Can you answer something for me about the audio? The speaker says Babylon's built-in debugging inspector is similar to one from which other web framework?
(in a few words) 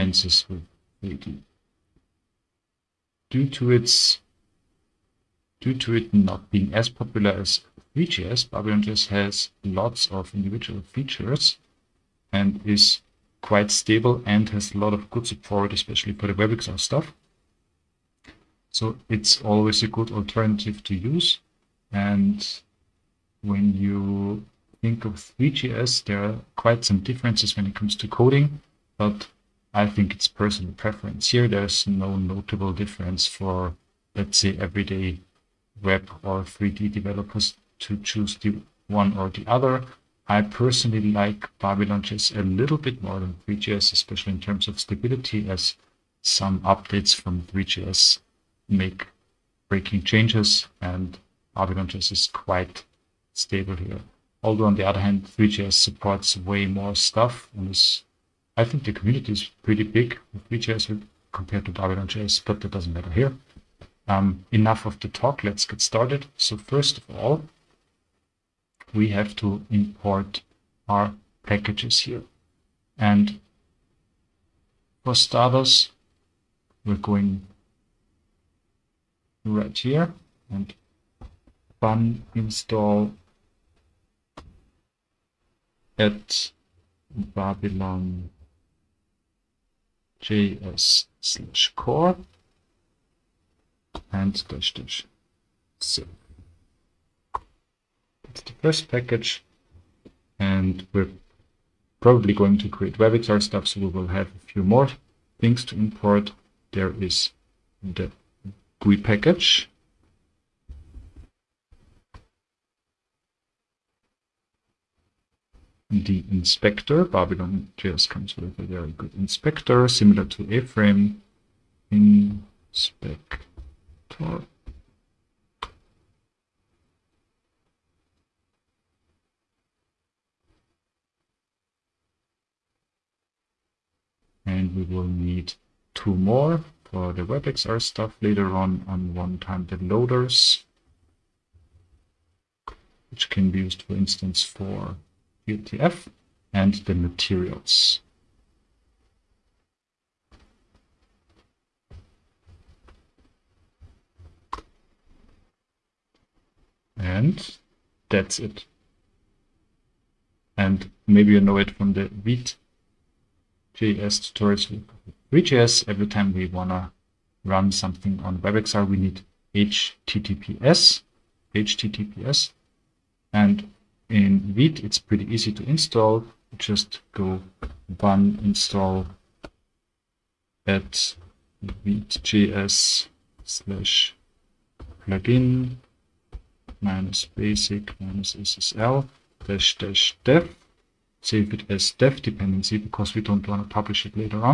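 A-frame.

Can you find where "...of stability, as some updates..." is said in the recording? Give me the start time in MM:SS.
00:44.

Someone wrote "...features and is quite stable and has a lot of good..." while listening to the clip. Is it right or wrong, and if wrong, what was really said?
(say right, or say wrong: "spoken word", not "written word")
right.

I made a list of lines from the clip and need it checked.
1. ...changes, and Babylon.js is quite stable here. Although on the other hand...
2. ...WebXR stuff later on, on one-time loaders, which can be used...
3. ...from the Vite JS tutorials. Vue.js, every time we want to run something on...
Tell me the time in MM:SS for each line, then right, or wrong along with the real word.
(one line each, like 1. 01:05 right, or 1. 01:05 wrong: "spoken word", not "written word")
1. 00:50 right
2. 02:17 right
3. 02:41 right.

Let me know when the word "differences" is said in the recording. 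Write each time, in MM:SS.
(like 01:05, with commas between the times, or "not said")
00:27, 00:32.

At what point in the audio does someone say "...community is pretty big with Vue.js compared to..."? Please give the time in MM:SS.
00:58.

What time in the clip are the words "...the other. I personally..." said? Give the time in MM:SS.
00:39.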